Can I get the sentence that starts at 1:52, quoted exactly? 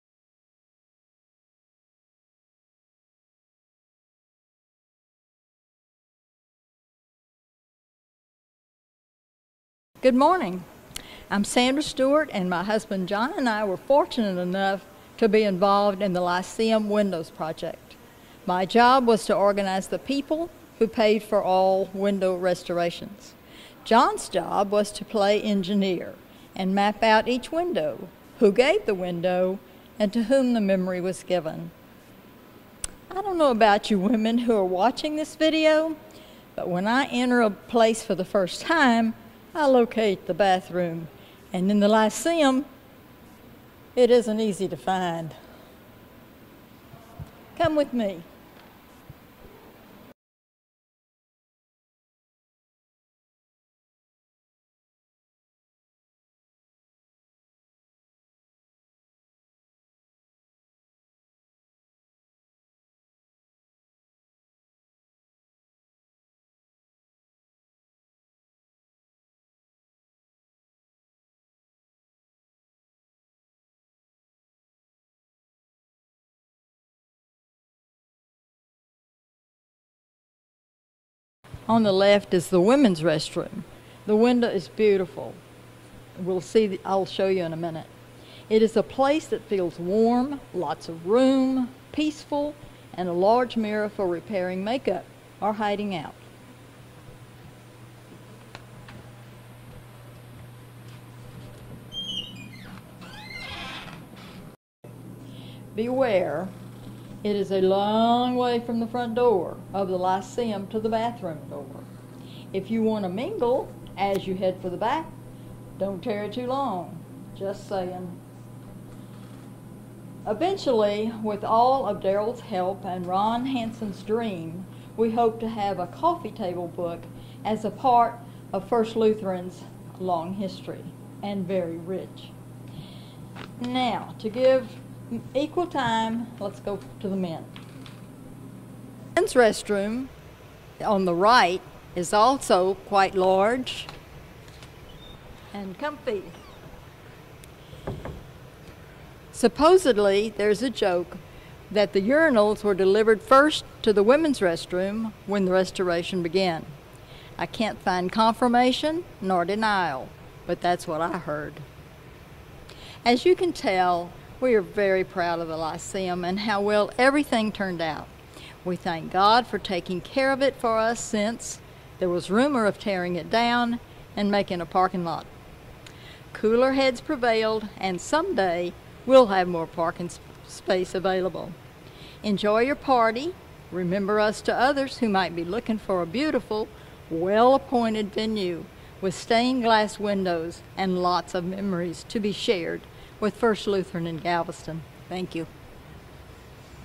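If you want to mingle as you head for the back, don't tarry too long.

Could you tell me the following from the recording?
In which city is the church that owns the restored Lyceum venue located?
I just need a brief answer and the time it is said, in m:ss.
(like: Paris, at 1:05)
Galveston, at 3:14.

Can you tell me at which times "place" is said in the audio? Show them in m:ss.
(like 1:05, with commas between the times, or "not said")
0:37, 1:28.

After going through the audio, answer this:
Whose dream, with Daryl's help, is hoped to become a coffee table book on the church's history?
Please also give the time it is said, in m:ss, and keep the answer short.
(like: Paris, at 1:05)
Ron Hansen, at 2:03.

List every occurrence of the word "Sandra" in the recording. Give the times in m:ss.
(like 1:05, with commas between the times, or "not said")
0:11.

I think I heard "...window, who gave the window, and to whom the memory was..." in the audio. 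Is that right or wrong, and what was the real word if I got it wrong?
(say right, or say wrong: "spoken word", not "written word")
right.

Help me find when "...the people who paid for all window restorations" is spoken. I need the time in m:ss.
0:19.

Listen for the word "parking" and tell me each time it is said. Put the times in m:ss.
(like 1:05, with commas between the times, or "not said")
2:54, 2:59.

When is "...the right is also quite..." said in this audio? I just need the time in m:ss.
2:21.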